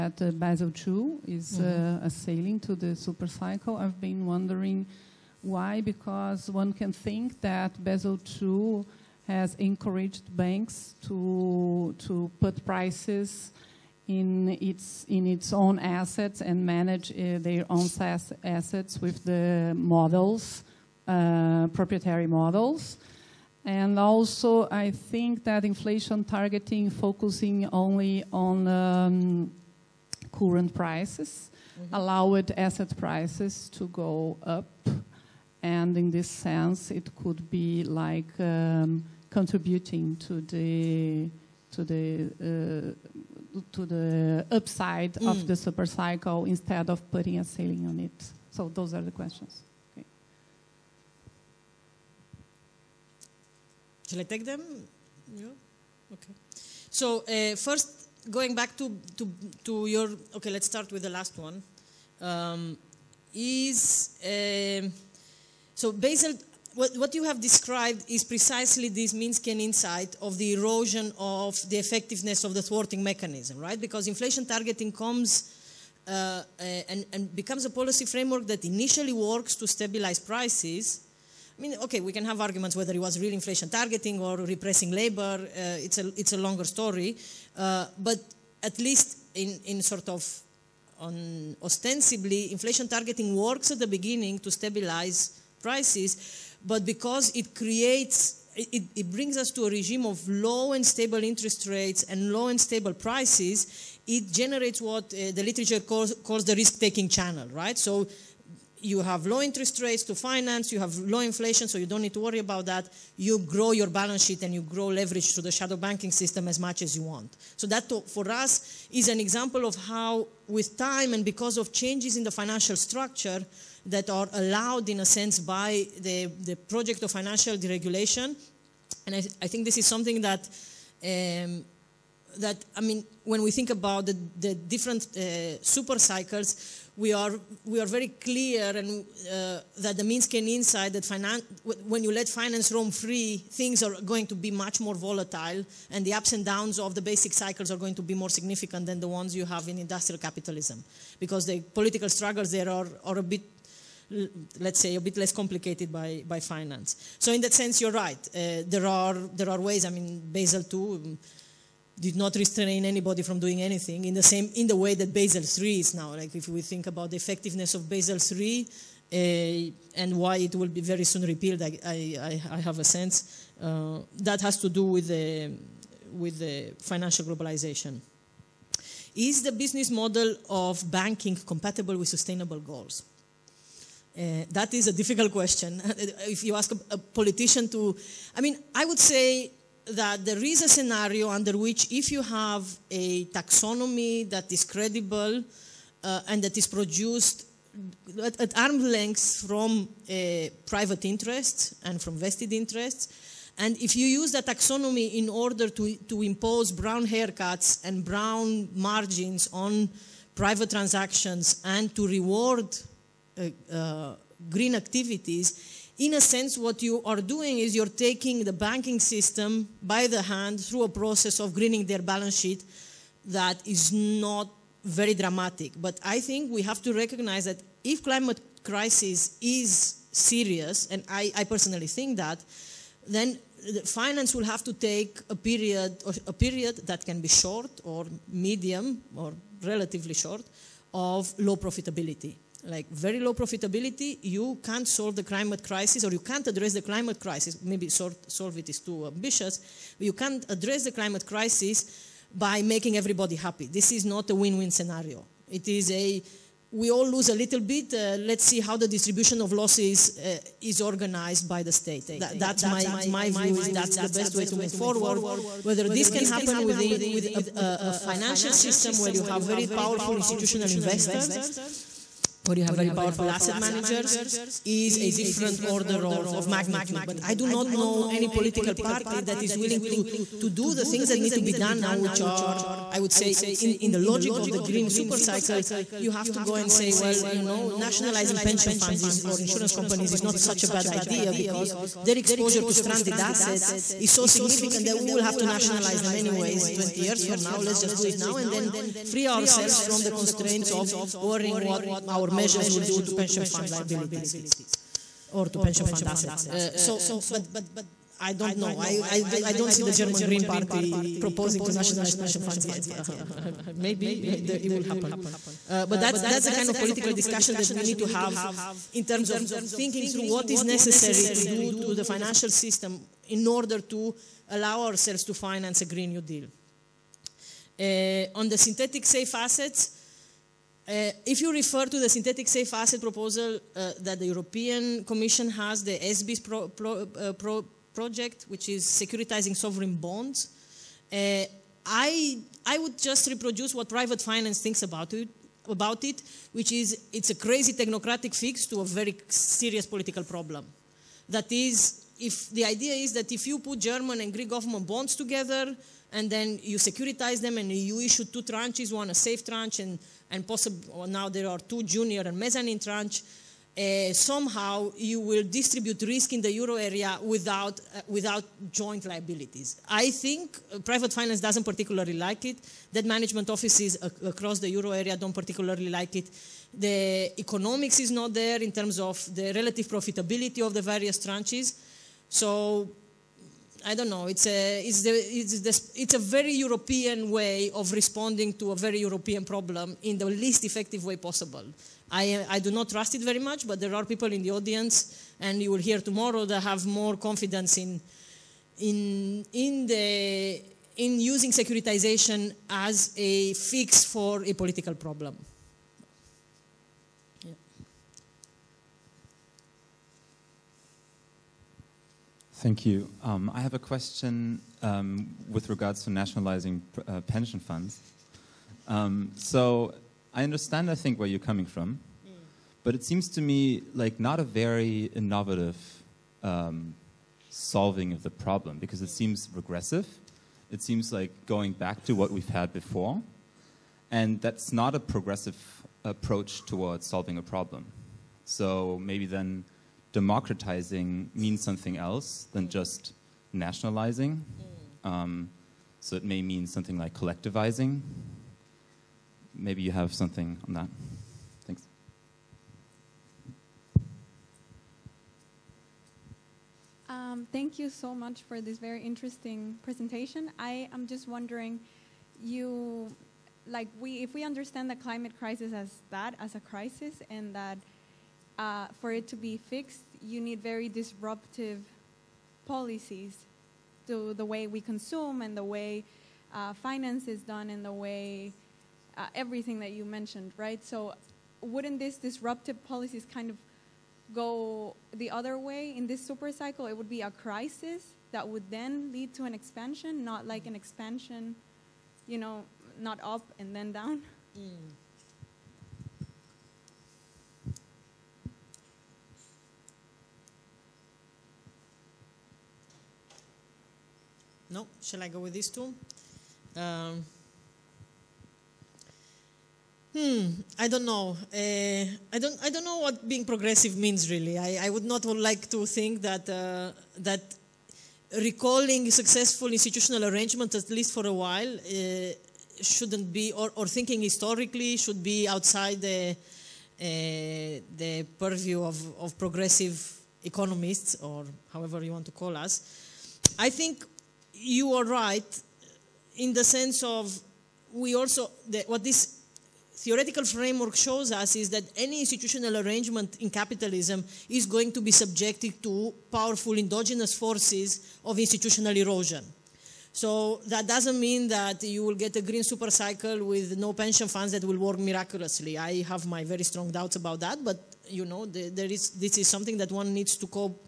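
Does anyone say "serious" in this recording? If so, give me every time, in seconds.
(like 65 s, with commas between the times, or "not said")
230 s, 349 s.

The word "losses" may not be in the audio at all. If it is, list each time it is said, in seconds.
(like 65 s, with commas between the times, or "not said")
259 s.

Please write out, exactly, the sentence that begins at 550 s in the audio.
So that doesn't mean that you will get a green super cycle with no pension funds that will work miraculously.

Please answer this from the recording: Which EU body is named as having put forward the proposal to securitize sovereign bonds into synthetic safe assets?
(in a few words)
European Commission.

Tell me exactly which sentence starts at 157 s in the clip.
So in that sense, you're right.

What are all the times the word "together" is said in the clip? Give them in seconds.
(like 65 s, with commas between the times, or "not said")
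355 s.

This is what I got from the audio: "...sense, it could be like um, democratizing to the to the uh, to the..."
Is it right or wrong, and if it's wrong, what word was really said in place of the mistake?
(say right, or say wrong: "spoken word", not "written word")
wrong: "contributing", not "democratizing".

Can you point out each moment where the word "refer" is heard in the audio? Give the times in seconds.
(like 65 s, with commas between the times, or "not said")
331 s.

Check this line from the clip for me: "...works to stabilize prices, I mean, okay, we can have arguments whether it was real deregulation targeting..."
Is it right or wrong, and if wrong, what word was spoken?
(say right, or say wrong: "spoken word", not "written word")
wrong: "inflation", not "deregulation".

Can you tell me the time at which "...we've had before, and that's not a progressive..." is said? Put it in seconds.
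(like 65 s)
432 s.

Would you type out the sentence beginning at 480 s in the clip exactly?
So wouldn't these disruptive policies kind of go the other way in this super cycle?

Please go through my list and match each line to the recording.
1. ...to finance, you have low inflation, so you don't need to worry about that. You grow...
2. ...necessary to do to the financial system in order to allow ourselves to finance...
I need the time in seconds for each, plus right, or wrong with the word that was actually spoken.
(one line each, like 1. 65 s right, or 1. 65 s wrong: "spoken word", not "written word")
1. 110 s right
2. 320 s right.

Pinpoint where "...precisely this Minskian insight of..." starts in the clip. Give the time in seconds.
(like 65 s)
68 s.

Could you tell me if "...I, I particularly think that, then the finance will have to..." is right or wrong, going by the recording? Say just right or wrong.
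wrong.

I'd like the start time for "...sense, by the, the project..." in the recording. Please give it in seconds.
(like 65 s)
125 s.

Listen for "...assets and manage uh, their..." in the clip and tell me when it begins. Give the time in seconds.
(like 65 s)
15 s.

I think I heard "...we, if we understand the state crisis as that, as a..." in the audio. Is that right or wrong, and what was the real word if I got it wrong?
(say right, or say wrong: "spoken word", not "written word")
wrong: "climate", not "state".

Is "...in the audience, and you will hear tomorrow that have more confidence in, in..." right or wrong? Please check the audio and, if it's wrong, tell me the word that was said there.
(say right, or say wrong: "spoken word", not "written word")
right.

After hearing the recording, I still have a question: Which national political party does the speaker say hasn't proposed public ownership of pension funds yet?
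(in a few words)
German Green Party.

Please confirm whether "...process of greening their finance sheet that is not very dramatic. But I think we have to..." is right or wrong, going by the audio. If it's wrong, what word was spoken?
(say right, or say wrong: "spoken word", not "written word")
wrong: "balance", not "finance".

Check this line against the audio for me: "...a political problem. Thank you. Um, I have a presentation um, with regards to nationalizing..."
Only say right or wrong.
wrong.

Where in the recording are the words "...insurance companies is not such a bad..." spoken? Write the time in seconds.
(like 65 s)
289 s.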